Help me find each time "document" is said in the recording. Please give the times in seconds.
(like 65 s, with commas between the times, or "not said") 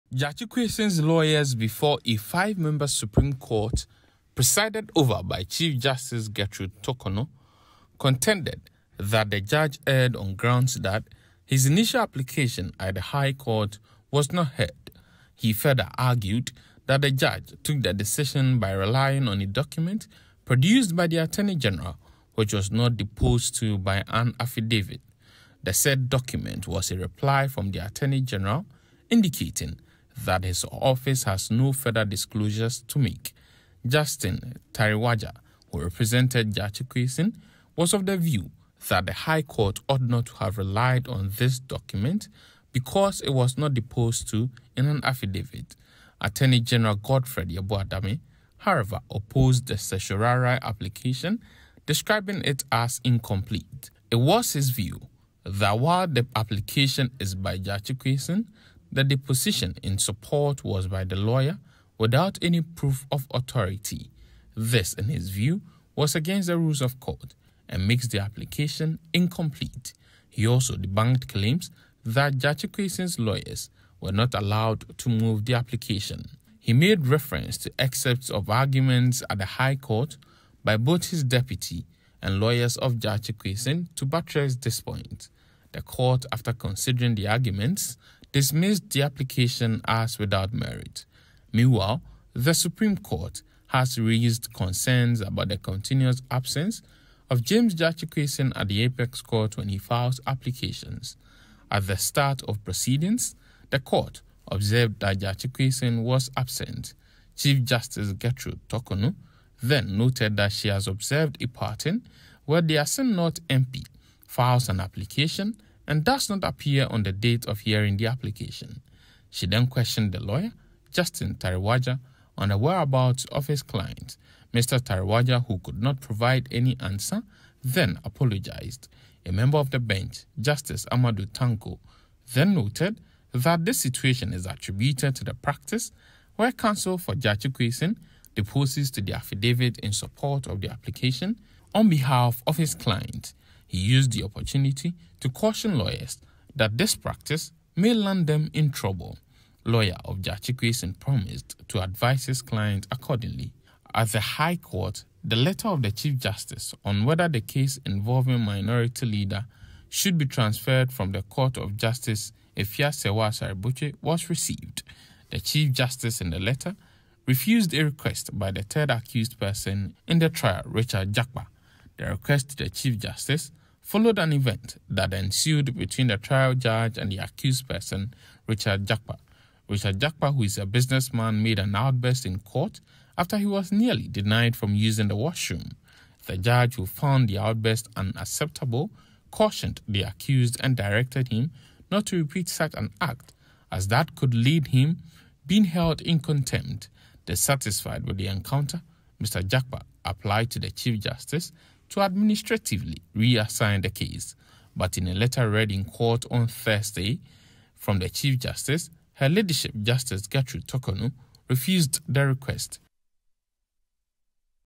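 19 s, 26 s, 41 s.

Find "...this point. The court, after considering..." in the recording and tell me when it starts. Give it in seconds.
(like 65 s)
84 s.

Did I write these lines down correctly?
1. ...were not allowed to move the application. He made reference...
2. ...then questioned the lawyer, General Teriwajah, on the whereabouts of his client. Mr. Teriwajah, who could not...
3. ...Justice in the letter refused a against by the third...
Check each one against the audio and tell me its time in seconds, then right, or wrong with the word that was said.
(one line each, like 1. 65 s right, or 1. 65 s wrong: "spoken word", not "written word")
1. 74 s right
2. 119 s wrong: "Justin", not "General"
3. 165 s wrong: "request", not "against".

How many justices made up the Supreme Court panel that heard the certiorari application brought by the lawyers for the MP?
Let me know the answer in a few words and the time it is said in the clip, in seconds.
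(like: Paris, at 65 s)
5, at 2 s.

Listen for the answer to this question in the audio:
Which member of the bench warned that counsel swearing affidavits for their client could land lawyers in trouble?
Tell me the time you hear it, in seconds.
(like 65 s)
130 s.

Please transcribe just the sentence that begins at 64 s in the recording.
This, in his view, was against the rules of court and makes the application incomplete.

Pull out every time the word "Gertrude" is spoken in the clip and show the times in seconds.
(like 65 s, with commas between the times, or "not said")
6 s, 108 s, 210 s.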